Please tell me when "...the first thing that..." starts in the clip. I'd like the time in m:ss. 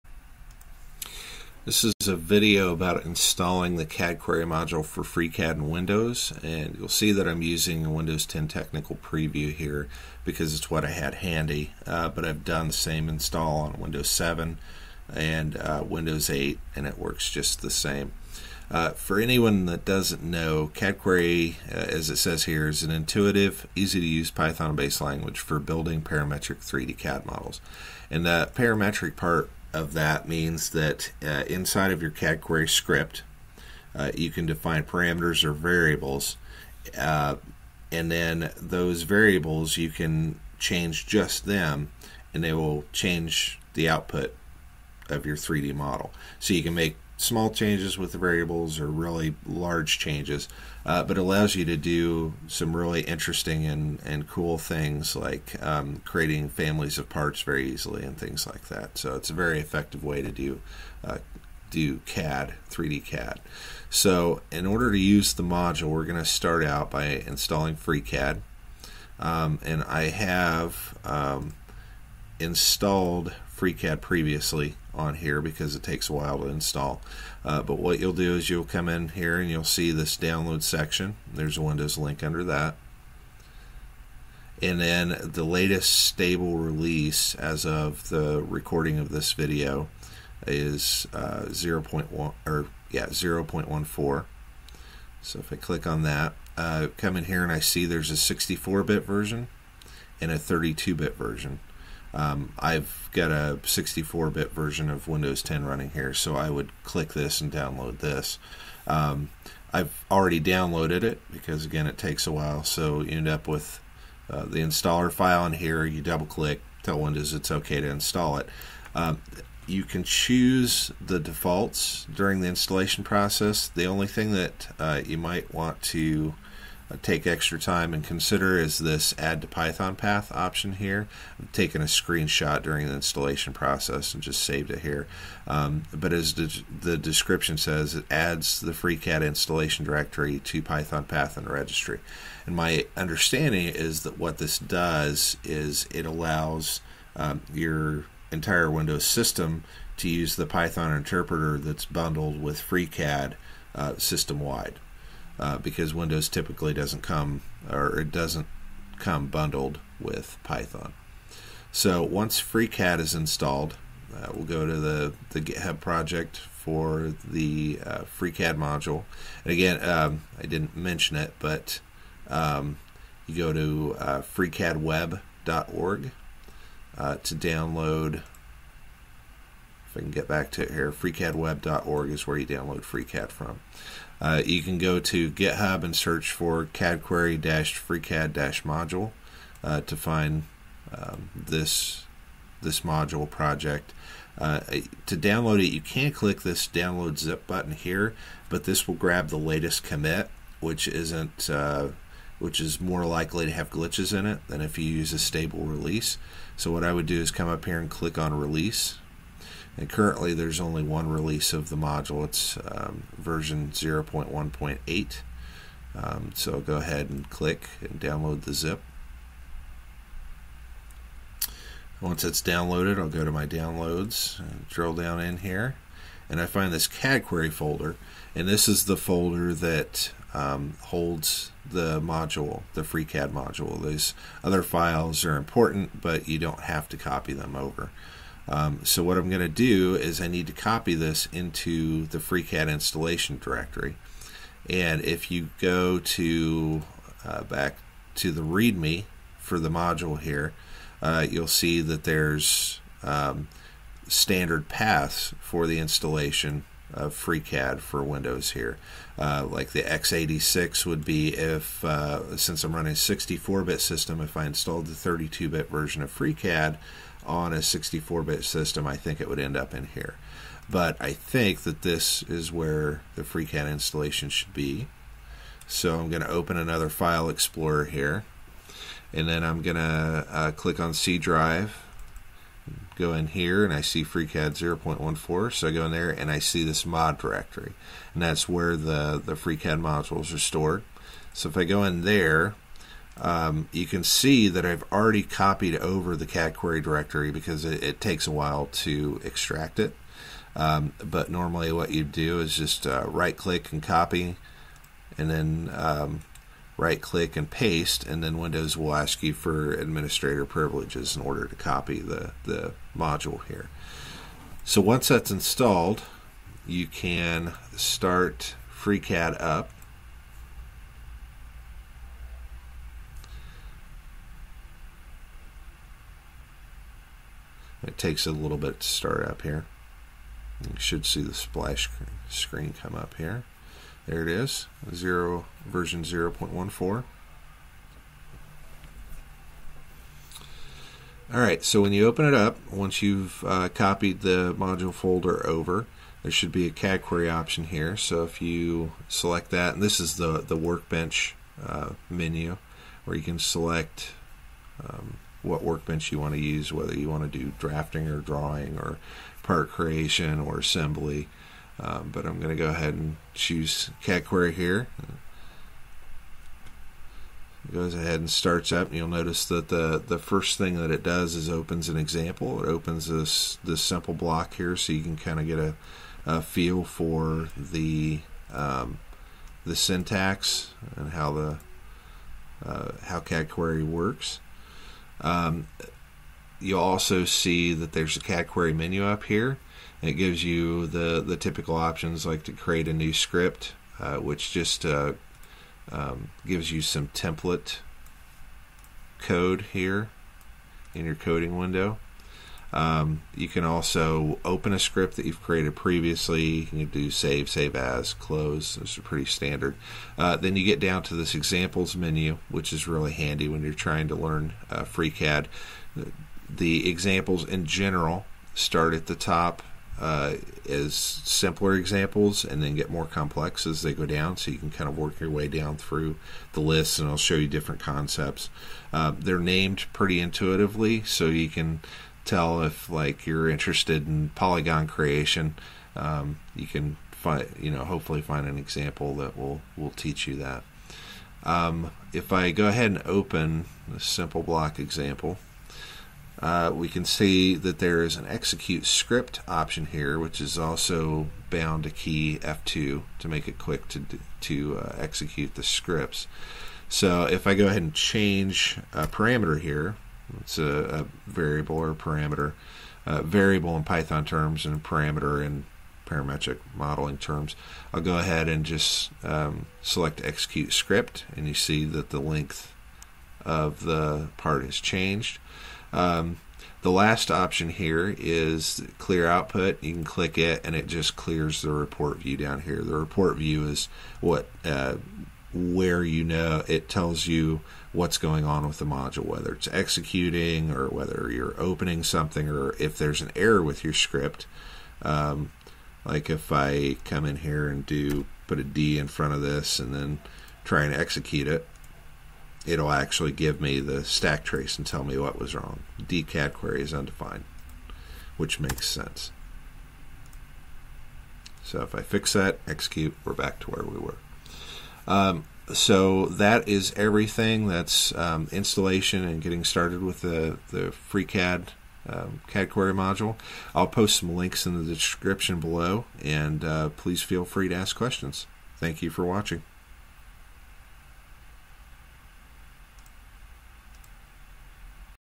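6:10.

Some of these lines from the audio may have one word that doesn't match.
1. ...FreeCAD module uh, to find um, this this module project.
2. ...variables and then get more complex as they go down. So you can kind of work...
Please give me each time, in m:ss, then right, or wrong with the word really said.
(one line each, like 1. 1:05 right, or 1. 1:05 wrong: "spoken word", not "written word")
1. 3:07 right
2. 7:01 wrong: "examples", not "variables".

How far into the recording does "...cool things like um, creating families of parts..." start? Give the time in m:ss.
0:54.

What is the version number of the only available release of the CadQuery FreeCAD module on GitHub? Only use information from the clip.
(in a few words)
0.1.8.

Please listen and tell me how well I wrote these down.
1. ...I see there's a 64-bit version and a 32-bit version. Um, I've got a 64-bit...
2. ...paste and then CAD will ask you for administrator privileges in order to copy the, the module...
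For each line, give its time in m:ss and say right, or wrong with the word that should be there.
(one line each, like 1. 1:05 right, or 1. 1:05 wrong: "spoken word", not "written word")
1. 1:37 right
2. 5:07 wrong: "Windows", not "CAD".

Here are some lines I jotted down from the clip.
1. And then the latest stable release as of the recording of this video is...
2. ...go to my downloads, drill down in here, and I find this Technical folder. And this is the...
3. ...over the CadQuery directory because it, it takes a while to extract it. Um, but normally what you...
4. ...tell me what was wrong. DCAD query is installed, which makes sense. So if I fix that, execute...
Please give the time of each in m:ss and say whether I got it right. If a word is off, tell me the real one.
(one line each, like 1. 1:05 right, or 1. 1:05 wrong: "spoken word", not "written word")
1. 1:24 right
2. 3:43 wrong: "CadQuery", not "Technical"
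3. 4:55 right
4. 8:24 wrong: "undefined", not "installed".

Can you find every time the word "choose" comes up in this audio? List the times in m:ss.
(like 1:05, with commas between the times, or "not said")
2:00, 6:03.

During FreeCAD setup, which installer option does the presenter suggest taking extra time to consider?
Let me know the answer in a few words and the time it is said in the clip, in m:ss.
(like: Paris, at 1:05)
add to Python path, at 2:09.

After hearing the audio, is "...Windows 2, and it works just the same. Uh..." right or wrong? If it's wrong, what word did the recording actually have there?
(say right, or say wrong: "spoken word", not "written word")
wrong: "8", not "2".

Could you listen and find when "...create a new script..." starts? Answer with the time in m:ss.
6:32.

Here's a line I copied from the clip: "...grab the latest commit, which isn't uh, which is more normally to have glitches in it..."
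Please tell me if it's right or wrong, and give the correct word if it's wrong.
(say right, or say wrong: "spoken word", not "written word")
wrong: "likely", not "normally".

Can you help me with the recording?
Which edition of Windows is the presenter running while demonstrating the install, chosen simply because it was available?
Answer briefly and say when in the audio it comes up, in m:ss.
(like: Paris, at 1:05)
Windows 10 Technical Preview, at 0:07.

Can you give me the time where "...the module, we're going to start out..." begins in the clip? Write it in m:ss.
1:05.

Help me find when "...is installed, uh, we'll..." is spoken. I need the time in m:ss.
2:42.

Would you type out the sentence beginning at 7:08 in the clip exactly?
Uh, they're named pretty intuitively, so you can tell if like you're interested in polygon creation.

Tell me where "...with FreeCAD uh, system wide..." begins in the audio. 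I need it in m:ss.
2:32.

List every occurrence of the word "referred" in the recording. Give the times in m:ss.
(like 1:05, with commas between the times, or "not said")
not said.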